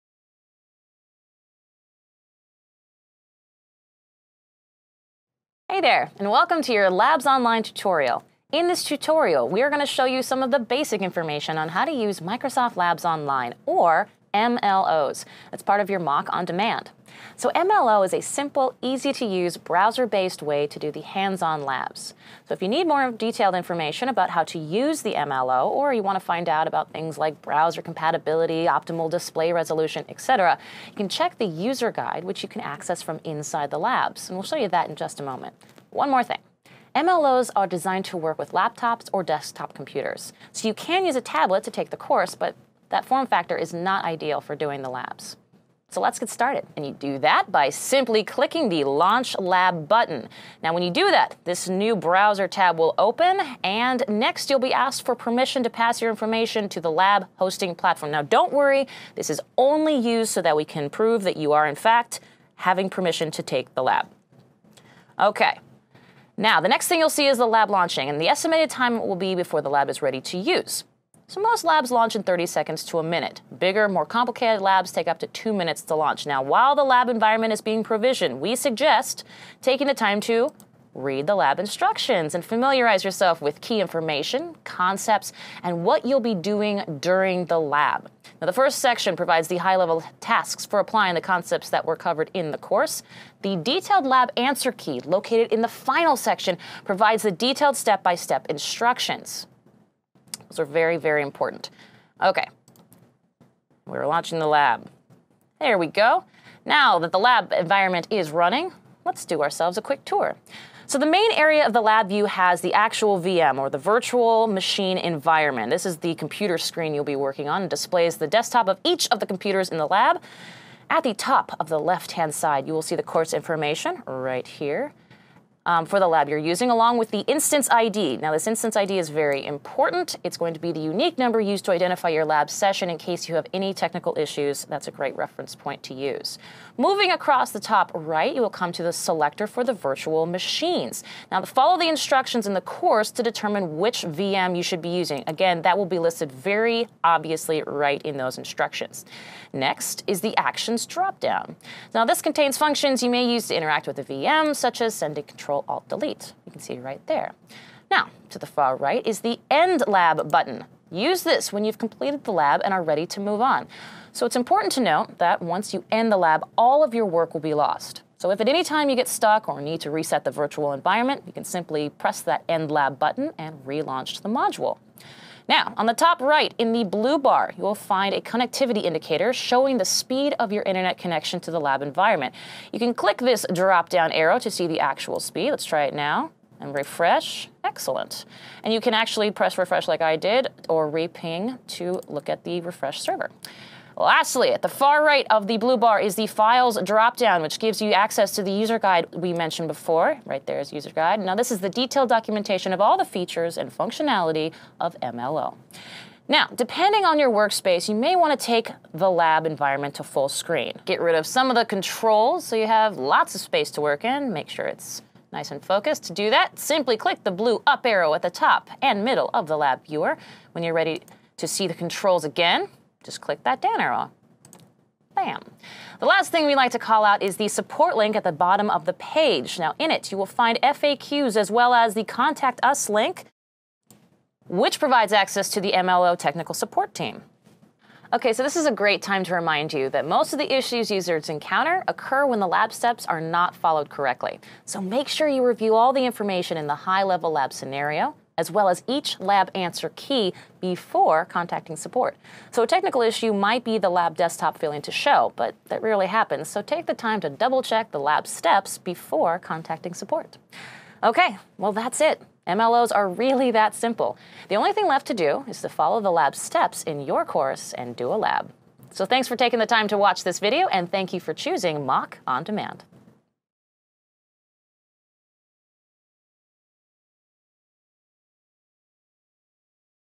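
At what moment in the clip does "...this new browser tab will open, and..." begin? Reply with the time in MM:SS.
00:51.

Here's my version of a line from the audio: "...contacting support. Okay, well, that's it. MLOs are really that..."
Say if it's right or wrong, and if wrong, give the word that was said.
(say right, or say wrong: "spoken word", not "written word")
right.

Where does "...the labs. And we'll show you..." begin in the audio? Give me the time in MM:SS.
00:33.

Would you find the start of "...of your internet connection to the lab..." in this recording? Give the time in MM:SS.
03:00.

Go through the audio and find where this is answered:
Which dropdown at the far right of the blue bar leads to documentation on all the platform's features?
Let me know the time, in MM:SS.
03:16.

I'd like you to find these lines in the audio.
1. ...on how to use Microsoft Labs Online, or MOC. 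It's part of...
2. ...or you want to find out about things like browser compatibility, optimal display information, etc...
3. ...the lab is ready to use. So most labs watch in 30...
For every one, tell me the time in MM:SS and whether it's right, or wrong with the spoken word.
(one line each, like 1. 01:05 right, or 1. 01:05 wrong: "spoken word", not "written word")
1. 00:11 wrong: "MLOs", not "MOC"
2. 00:25 wrong: "resolution", not "information"
3. 01:09 wrong: "launch", not "watch".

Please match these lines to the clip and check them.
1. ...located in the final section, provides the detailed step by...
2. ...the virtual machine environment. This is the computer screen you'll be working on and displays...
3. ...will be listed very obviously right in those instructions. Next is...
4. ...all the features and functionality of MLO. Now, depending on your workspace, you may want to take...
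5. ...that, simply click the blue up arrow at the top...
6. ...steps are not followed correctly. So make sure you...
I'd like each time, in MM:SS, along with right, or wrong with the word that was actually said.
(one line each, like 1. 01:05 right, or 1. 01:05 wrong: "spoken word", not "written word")
1. 01:35 right
2. 01:53 right
3. 02:25 right
4. 03:22 right
5. 03:36 right
6. 04:02 right.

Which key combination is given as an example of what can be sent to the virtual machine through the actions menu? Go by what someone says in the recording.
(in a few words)
Control Alt Delete.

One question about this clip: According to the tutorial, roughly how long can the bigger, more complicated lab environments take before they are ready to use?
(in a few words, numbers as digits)
2 minutes.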